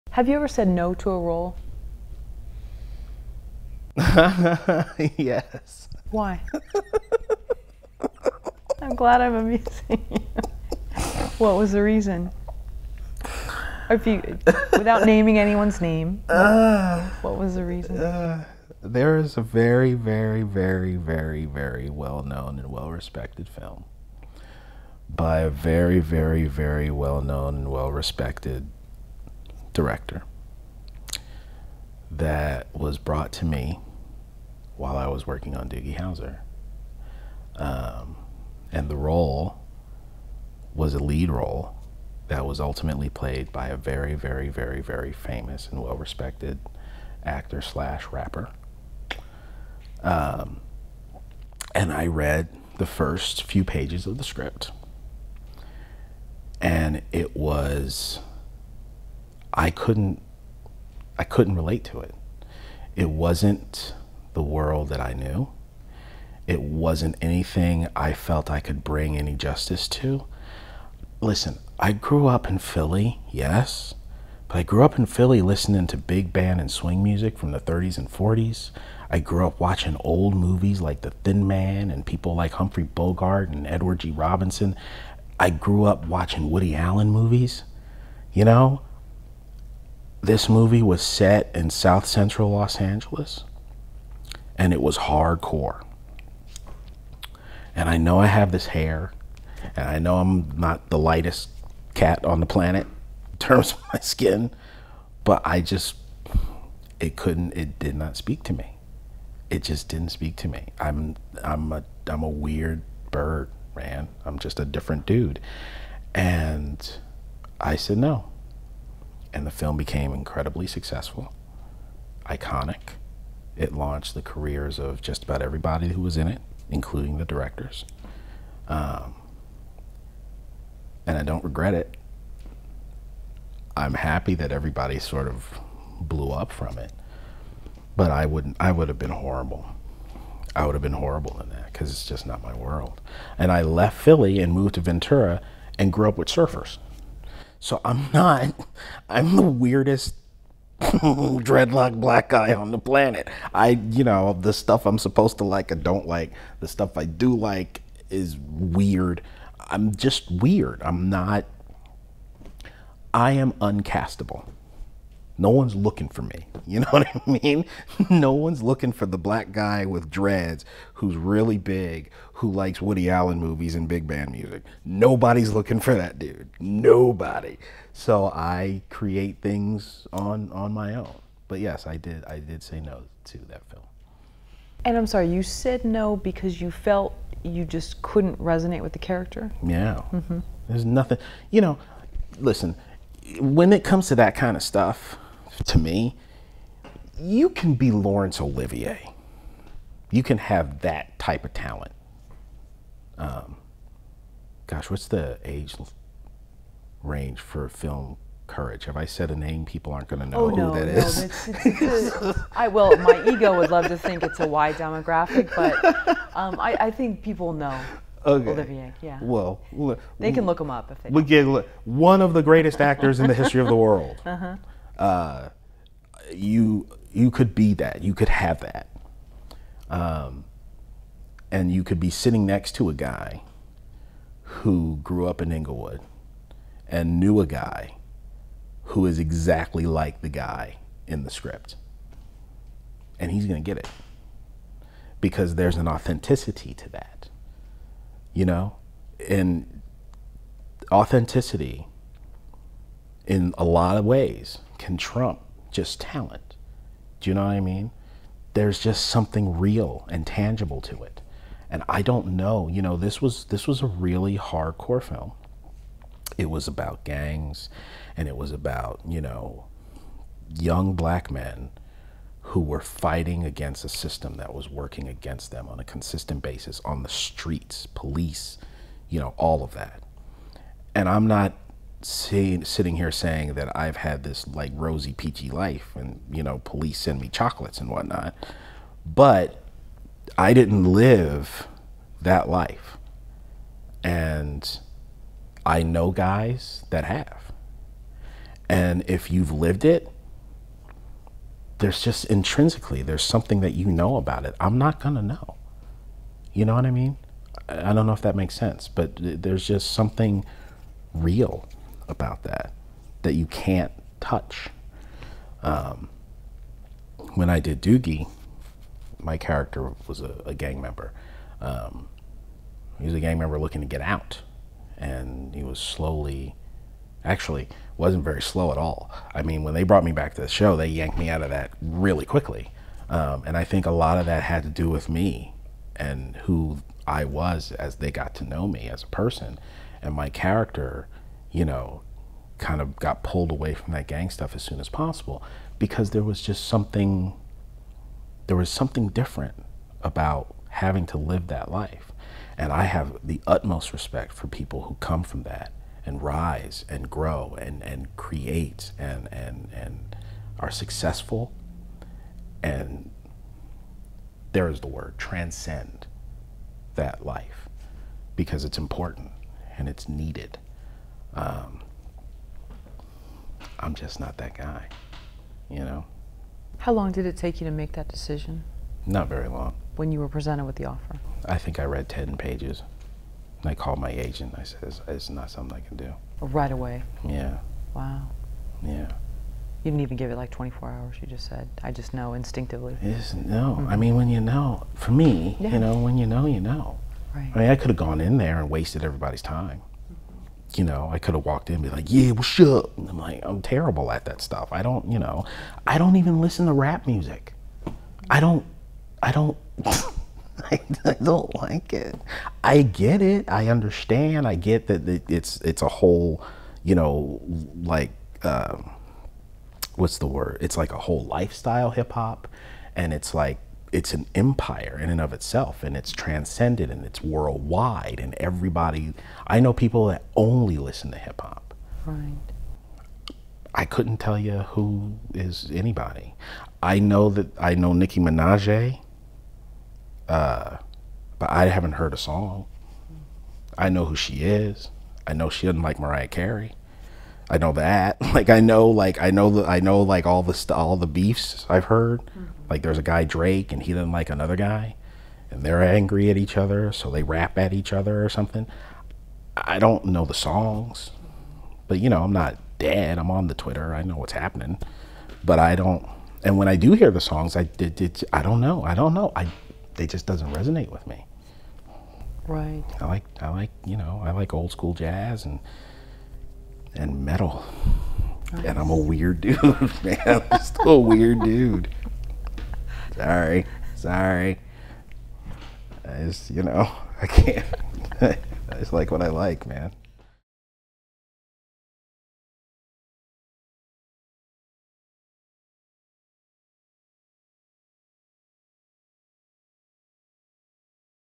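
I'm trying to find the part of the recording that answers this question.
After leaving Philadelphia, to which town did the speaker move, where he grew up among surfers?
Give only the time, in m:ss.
2:24.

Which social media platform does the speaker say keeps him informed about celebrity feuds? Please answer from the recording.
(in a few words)
Twitter.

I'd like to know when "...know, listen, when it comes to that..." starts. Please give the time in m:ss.
3:11.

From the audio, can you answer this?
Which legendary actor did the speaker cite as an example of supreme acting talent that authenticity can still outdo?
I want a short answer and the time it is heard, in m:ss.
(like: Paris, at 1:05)
Laurence Olivier, at 3:17.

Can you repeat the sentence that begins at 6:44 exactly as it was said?
I don't, you know, I don't even listen to rap music.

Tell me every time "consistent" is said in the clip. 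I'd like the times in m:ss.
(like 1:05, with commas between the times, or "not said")
4:35.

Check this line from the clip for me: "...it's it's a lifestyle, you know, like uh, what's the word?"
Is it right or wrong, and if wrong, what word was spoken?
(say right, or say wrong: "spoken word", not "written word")
wrong: "whole", not "lifestyle".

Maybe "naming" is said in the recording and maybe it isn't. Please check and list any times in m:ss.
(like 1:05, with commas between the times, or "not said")
0:15.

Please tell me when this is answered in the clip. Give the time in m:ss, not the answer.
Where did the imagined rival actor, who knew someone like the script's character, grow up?
3:55.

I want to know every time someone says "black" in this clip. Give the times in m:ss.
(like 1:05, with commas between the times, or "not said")
2:32, 2:49, 4:30.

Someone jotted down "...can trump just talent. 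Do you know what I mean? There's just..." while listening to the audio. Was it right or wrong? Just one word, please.
right.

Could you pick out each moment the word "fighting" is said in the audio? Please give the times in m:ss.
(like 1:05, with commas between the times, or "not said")
4:32.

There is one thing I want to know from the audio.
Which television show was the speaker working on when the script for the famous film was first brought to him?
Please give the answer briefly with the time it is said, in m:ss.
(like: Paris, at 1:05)
Doogie Howser, at 0:35.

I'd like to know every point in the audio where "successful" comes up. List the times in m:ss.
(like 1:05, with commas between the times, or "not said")
2:00, 6:00.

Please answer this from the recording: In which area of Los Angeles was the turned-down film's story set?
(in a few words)
South Central.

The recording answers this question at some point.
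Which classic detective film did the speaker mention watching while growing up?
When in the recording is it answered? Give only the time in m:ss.
1:21.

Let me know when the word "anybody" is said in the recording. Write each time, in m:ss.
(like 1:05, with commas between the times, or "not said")
7:15.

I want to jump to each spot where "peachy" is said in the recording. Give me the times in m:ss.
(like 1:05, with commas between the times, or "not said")
4:45.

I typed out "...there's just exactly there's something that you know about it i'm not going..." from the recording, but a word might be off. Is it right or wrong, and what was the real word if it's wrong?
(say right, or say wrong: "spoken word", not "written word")
wrong: "intrinsically", not "exactly".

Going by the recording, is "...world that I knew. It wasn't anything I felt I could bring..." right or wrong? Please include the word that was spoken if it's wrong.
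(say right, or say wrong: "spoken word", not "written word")
right.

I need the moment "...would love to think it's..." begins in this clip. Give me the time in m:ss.
3:33.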